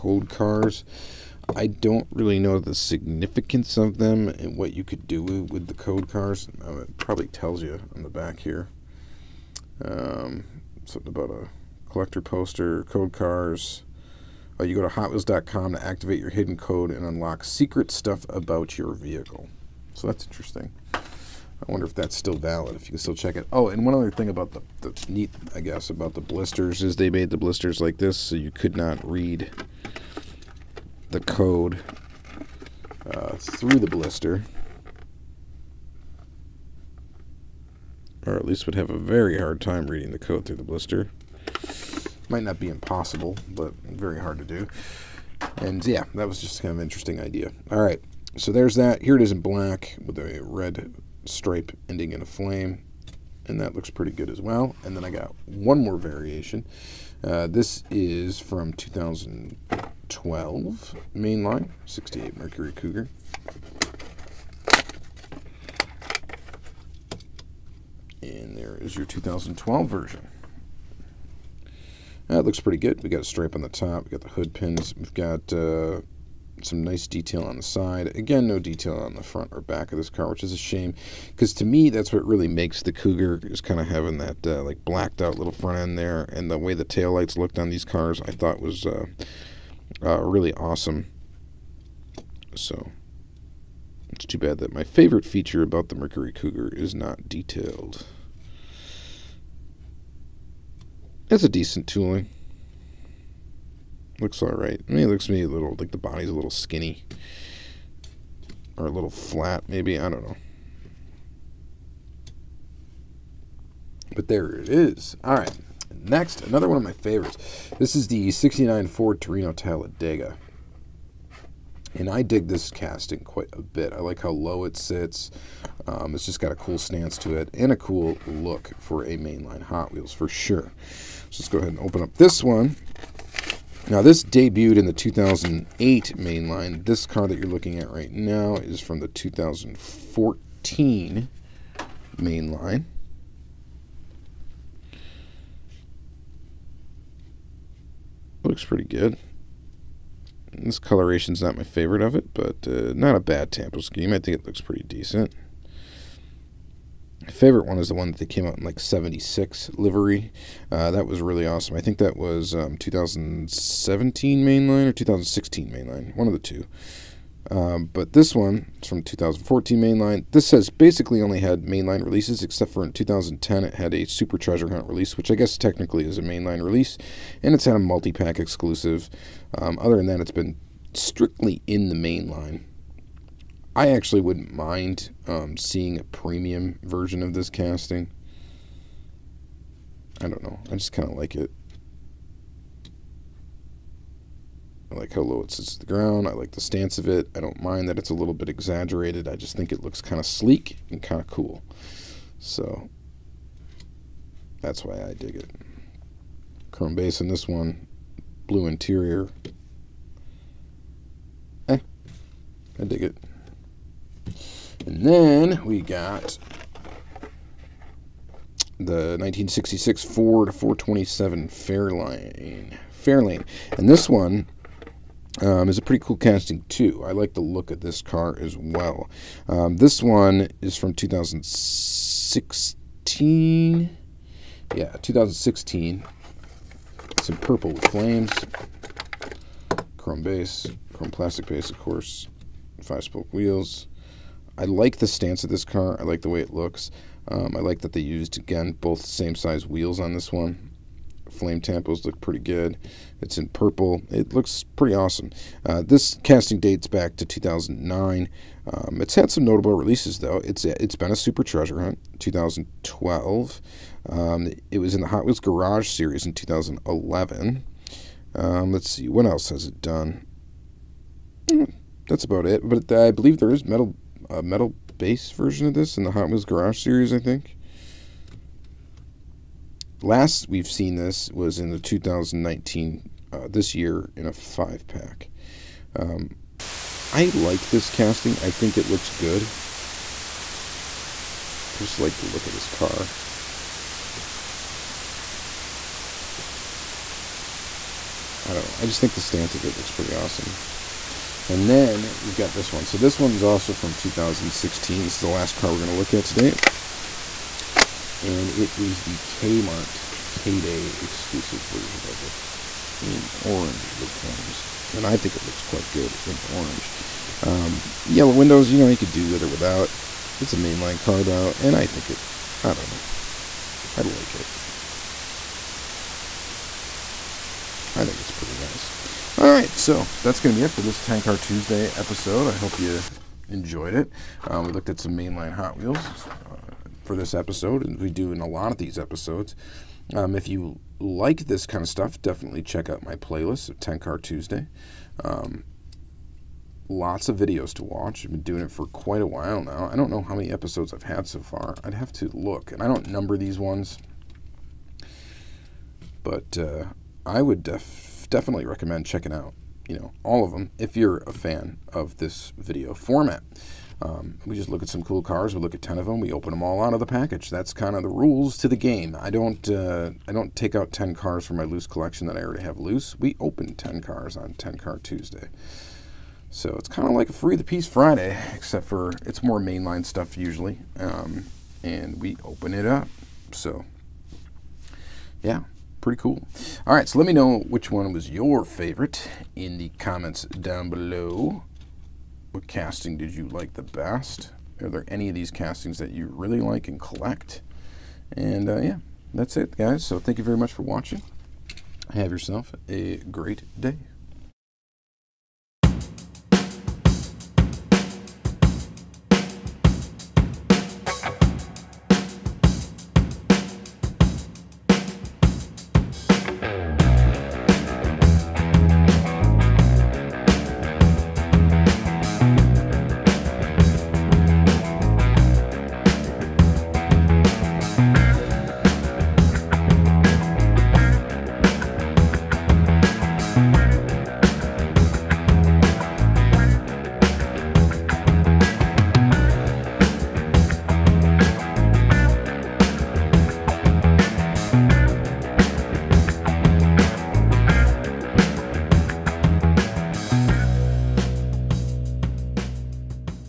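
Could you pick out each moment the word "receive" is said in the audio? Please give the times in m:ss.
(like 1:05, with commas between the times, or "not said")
not said.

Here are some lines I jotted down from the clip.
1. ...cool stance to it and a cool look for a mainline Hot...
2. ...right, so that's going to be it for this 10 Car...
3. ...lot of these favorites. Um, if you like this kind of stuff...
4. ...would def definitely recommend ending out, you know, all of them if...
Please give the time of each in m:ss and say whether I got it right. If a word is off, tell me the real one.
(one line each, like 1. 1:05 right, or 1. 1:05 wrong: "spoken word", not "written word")
1. 2:06 right
2. 5:29 right
3. 5:38 wrong: "episodes", not "favorites"
4. 5:57 wrong: "checking", not "ending".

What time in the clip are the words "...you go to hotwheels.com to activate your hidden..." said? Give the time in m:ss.
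0:14.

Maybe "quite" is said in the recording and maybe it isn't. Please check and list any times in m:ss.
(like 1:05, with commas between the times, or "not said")
2:03, 5:15, 5:48.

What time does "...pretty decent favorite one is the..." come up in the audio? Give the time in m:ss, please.
2:34.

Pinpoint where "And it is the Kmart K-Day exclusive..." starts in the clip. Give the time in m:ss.
5:08.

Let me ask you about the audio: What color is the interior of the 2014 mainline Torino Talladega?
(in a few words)
Blue.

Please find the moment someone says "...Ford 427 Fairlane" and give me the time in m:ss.
3:40.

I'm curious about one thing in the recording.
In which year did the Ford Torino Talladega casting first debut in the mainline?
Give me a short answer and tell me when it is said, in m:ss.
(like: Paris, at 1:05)
2008, at 2:14.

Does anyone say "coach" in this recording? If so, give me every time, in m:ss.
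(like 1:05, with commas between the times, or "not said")
not said.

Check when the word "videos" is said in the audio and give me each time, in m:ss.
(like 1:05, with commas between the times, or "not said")
5:47, 6:02.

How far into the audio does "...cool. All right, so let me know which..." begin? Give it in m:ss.
6:26.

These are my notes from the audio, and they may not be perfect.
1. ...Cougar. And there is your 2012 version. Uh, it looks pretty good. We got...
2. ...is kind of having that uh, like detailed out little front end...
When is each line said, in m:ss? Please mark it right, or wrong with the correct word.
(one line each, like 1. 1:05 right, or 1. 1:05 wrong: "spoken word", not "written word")
1. 1:02 right
2. 1:23 wrong: "blacked", not "detailed".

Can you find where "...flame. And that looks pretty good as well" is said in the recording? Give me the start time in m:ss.
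0:52.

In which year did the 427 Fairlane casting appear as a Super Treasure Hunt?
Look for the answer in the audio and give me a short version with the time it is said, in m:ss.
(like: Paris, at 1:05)
2012, at 4:21.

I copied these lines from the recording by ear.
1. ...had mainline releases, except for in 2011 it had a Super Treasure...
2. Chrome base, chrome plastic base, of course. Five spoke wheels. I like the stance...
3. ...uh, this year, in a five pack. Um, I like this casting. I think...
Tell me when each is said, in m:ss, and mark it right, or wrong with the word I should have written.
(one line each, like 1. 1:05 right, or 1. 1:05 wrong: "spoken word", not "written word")
1. 2:51 wrong: "2010", not "2011"
2. 3:59 right
3. 4:43 right.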